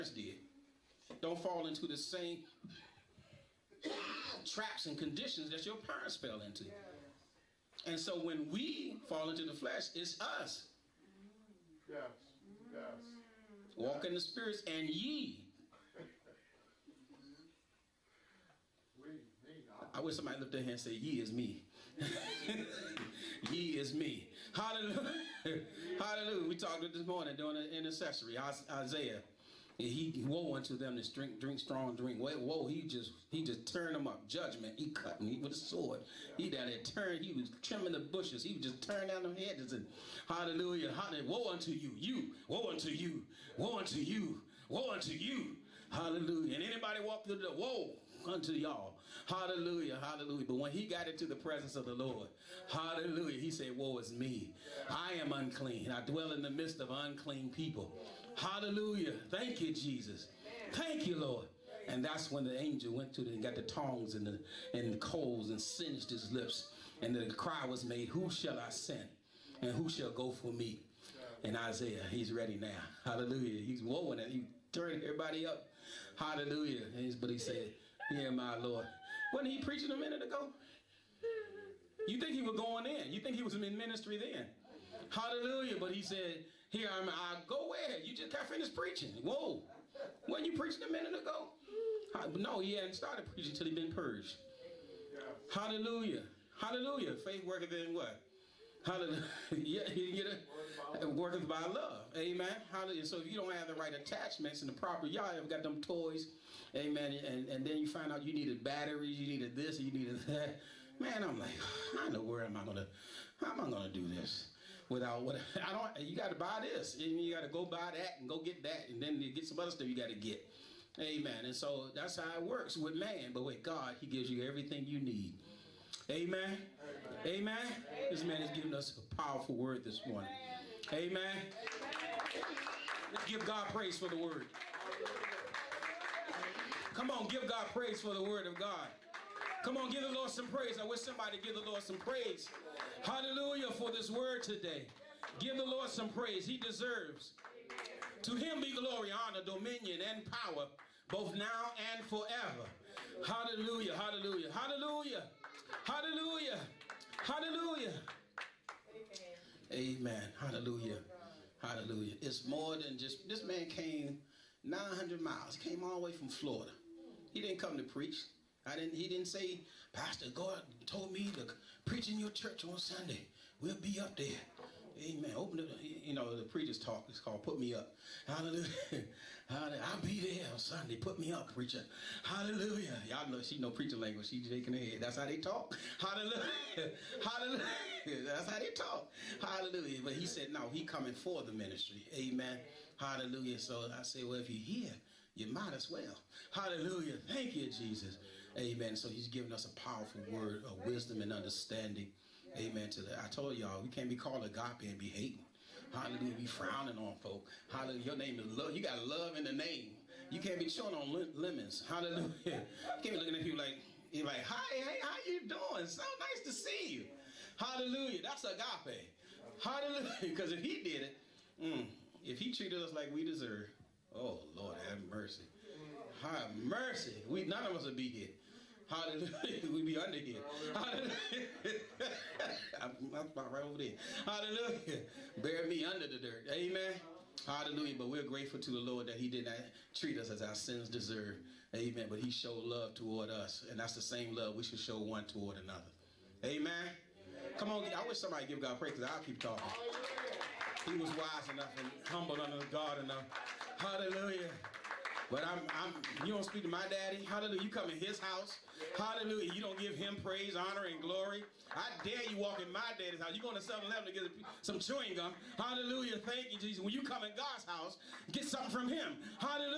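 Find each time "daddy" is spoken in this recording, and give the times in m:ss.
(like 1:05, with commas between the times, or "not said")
4:16, 4:22.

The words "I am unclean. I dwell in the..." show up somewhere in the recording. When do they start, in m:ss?
0:54.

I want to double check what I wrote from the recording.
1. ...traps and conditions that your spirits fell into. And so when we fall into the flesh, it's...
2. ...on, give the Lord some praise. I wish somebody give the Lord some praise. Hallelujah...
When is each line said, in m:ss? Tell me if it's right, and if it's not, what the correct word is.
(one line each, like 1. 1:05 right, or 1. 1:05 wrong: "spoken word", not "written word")
1. 0:04 wrong: "parents", not "spirits"
2. 2:19 right.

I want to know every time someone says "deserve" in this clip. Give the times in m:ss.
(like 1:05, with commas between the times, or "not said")
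2:26, 3:43, 4:00.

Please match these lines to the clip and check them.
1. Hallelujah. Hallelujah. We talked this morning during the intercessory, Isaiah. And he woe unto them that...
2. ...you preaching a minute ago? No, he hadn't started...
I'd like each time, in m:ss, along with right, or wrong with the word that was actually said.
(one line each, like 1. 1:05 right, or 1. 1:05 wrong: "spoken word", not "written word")
1. 0:24 right
2. 1:30 right.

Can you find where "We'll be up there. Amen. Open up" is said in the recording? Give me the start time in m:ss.
2:53.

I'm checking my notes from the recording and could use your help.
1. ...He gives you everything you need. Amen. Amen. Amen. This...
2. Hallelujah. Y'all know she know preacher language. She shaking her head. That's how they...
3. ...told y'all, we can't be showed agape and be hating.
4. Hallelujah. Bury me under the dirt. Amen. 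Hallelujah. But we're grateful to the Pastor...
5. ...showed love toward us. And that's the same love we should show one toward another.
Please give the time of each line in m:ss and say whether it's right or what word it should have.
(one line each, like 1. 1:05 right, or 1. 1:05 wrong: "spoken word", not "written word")
1. 2:03 right
2. 3:02 right
3. 3:23 wrong: "called", not "showed"
4. 3:53 wrong: "Lord", not "Pastor"
5. 4:02 right.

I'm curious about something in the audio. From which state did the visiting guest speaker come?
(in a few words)
Florida.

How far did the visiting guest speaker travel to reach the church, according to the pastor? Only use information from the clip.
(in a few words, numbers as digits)
900 miles.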